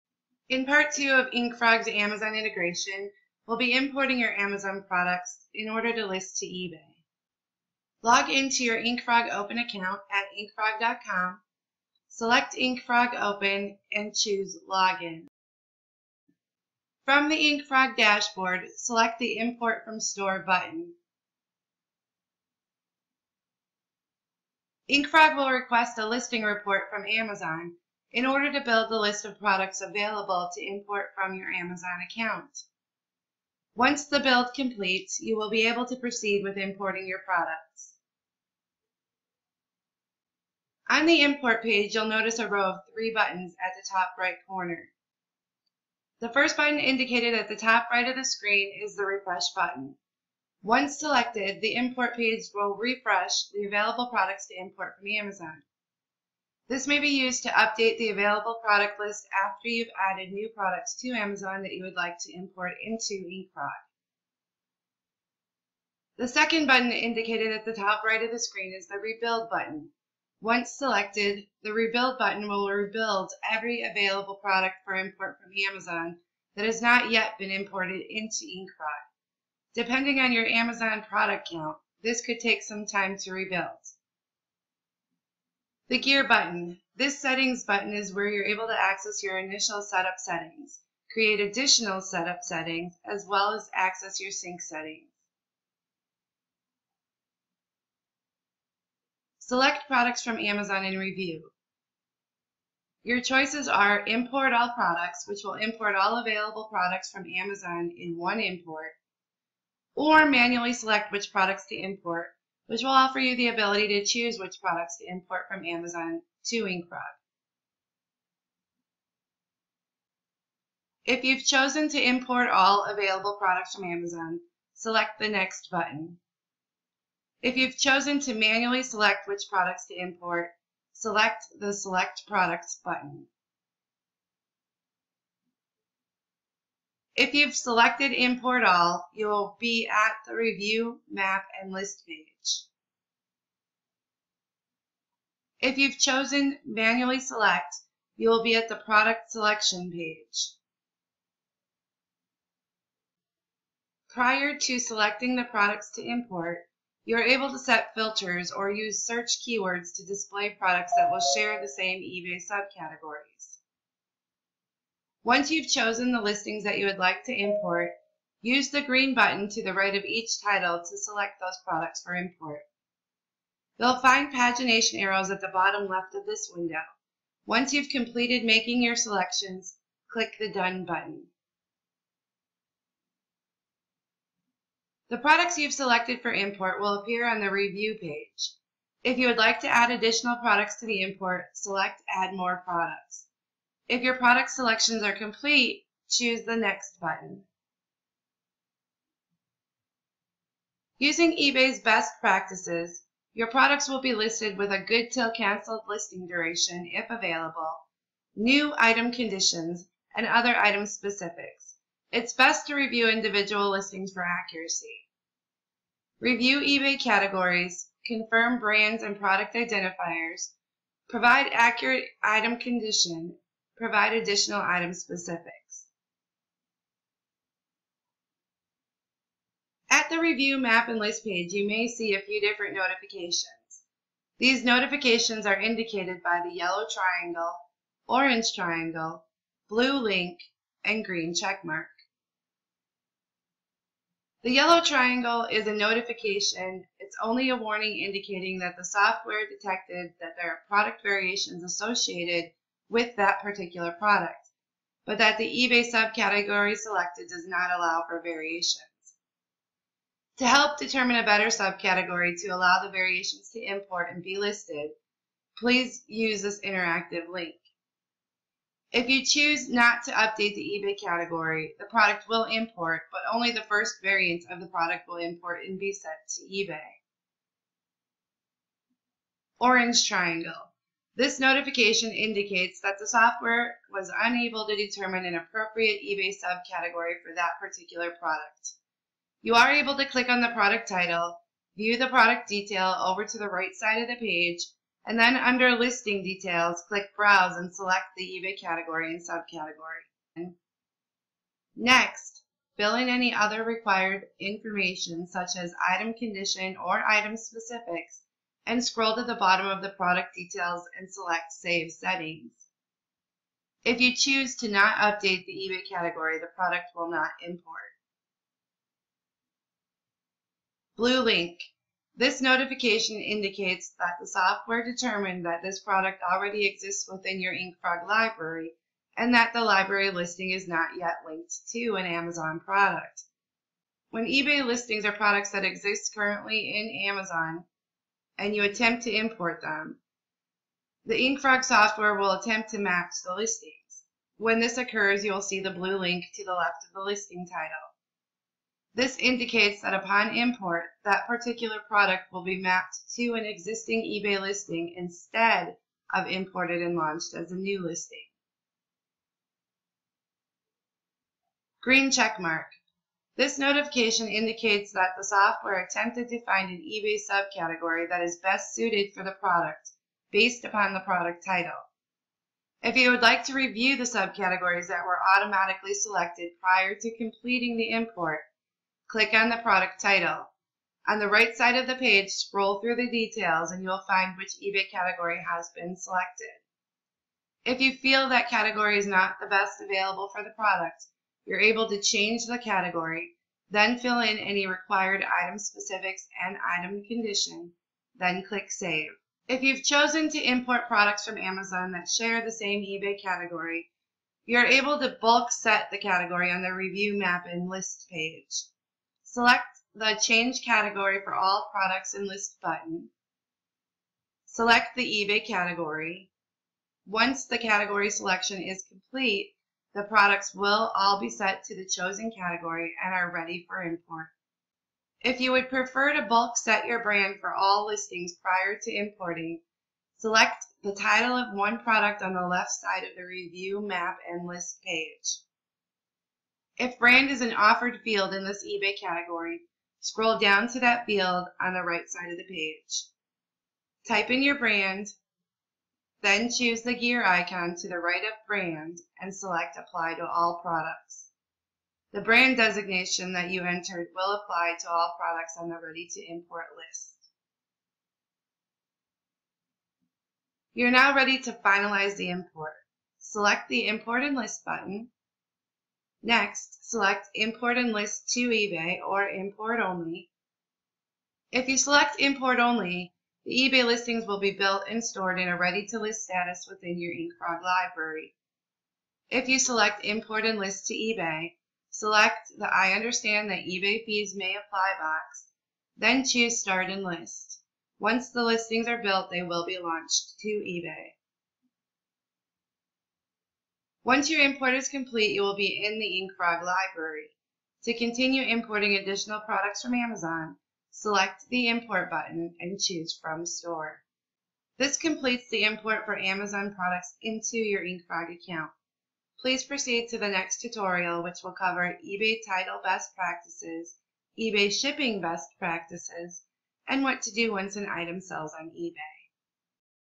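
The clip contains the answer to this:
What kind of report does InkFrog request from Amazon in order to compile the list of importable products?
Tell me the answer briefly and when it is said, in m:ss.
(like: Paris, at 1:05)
listing report, at 0:26.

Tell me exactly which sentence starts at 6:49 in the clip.
Select the Change Category for all products and list button.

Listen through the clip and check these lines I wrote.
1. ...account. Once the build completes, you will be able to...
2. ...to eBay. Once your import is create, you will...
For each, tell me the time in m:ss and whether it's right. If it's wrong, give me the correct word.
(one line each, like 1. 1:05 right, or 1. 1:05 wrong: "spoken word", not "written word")
1. 0:32 right
2. 8:10 wrong: "complete", not "create".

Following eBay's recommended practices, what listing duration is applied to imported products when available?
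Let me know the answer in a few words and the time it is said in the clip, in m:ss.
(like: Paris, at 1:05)
good till canceled, at 3:24.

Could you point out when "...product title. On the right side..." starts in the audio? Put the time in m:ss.
6:19.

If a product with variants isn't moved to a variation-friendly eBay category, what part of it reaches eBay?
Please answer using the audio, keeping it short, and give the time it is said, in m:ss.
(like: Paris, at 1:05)
only the first variant, at 4:33.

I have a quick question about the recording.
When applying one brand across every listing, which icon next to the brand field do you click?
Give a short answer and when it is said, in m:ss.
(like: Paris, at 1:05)
gear icon, at 7:26.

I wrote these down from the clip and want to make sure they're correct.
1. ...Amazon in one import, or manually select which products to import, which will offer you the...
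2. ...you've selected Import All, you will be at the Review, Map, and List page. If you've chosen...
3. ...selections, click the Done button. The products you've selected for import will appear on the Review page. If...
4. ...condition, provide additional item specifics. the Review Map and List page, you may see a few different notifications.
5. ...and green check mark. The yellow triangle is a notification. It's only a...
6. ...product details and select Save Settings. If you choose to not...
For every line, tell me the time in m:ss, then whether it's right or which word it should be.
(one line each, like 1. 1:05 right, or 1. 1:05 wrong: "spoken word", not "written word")
1. 1:47 right
2. 2:17 right
3. 2:58 right
4. 3:42 right
5. 4:00 right
6. 5:09 right.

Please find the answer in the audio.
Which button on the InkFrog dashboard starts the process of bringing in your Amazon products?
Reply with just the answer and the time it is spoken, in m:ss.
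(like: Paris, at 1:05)
Import from Store, at 0:19.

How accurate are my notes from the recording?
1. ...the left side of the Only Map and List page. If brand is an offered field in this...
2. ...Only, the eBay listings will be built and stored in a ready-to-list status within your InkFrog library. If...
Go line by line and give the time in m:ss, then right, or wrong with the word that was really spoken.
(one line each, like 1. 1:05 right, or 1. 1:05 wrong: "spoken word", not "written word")
1. 7:12 wrong: "Review", not "Only"
2. 7:52 right.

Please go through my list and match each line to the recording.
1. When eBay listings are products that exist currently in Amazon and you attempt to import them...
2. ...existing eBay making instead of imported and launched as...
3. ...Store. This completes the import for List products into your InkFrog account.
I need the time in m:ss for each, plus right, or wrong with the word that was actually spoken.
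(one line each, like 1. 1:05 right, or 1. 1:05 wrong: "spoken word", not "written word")
1. 5:34 right
2. 5:53 wrong: "listing", not "making"
3. 8:23 wrong: "Amazon", not "List".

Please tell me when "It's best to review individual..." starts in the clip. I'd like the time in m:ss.
3:32.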